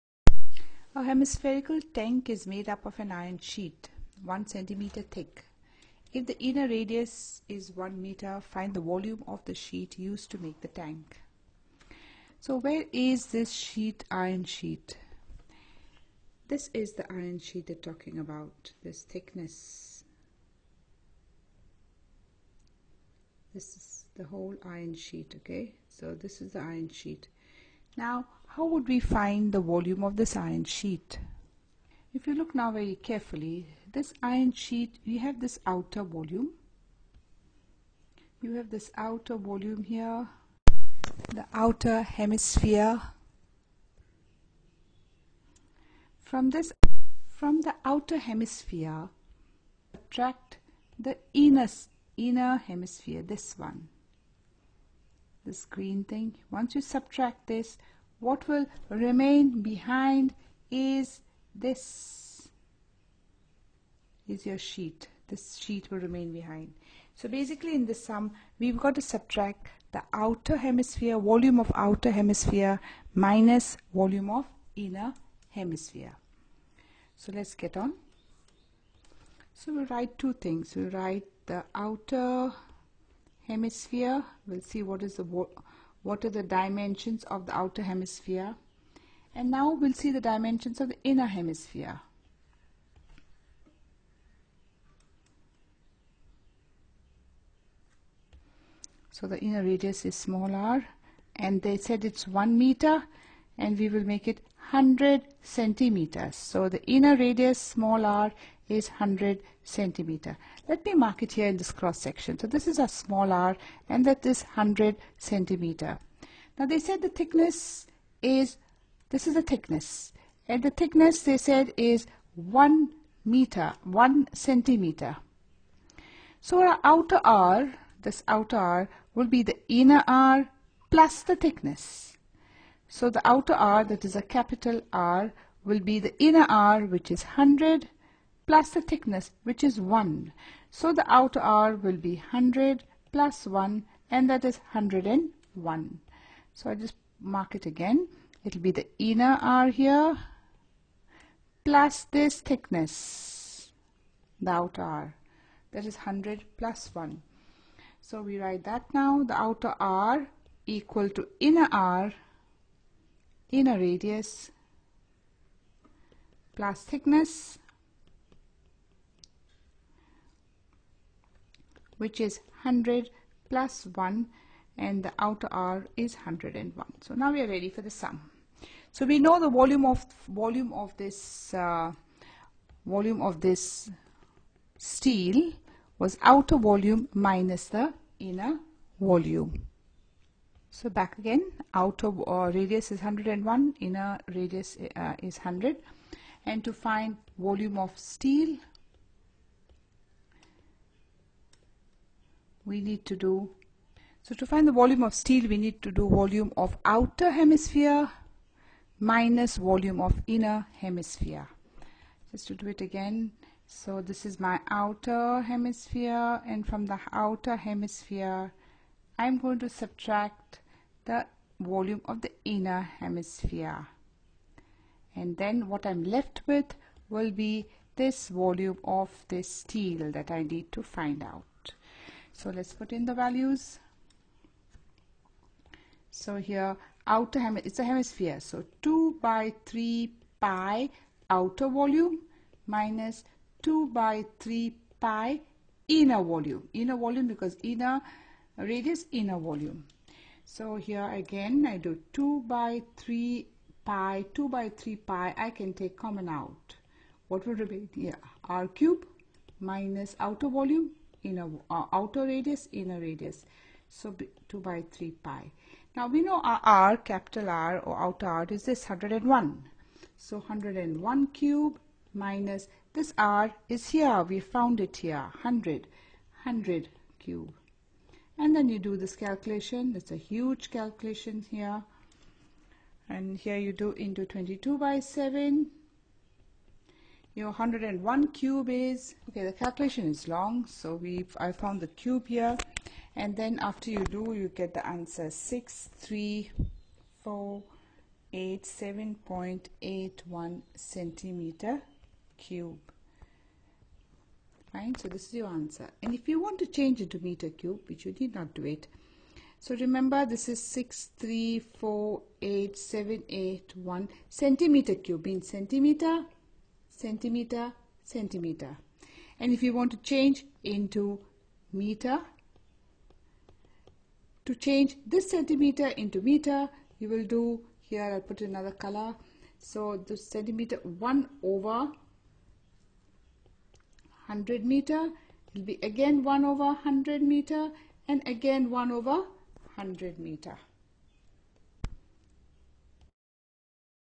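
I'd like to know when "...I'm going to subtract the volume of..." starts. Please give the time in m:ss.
3:39.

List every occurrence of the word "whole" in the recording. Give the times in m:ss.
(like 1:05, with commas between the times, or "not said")
0:24.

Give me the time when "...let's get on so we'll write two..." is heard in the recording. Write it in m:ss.
1:17.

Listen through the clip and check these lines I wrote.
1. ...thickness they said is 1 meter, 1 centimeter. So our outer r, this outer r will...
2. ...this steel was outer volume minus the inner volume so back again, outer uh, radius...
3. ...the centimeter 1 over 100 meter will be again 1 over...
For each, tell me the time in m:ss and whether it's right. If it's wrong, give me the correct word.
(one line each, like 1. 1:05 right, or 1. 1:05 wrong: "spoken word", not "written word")
1. 2:00 right
2. 3:03 right
3. 5:30 right.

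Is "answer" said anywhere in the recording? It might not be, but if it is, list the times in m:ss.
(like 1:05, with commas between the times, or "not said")
4:54, 5:05.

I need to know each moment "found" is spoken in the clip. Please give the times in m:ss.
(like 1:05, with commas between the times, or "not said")
4:34, 4:51.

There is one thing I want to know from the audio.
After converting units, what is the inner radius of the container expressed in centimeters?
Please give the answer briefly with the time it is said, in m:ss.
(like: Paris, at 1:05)
100 centimeters, at 1:43.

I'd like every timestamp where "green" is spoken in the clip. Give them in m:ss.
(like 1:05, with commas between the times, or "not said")
0:55.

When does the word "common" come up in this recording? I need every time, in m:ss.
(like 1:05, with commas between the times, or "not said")
4:15.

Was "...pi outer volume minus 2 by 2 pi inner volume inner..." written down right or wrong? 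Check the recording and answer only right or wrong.
wrong.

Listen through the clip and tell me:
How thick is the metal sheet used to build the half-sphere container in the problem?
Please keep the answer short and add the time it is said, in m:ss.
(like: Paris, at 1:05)
1 centimeter, at 0:04.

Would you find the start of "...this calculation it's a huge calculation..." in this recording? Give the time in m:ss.
4:38.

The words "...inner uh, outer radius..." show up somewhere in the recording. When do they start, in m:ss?
4:21.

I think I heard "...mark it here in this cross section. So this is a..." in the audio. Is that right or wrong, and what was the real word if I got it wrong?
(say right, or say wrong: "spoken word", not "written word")
right.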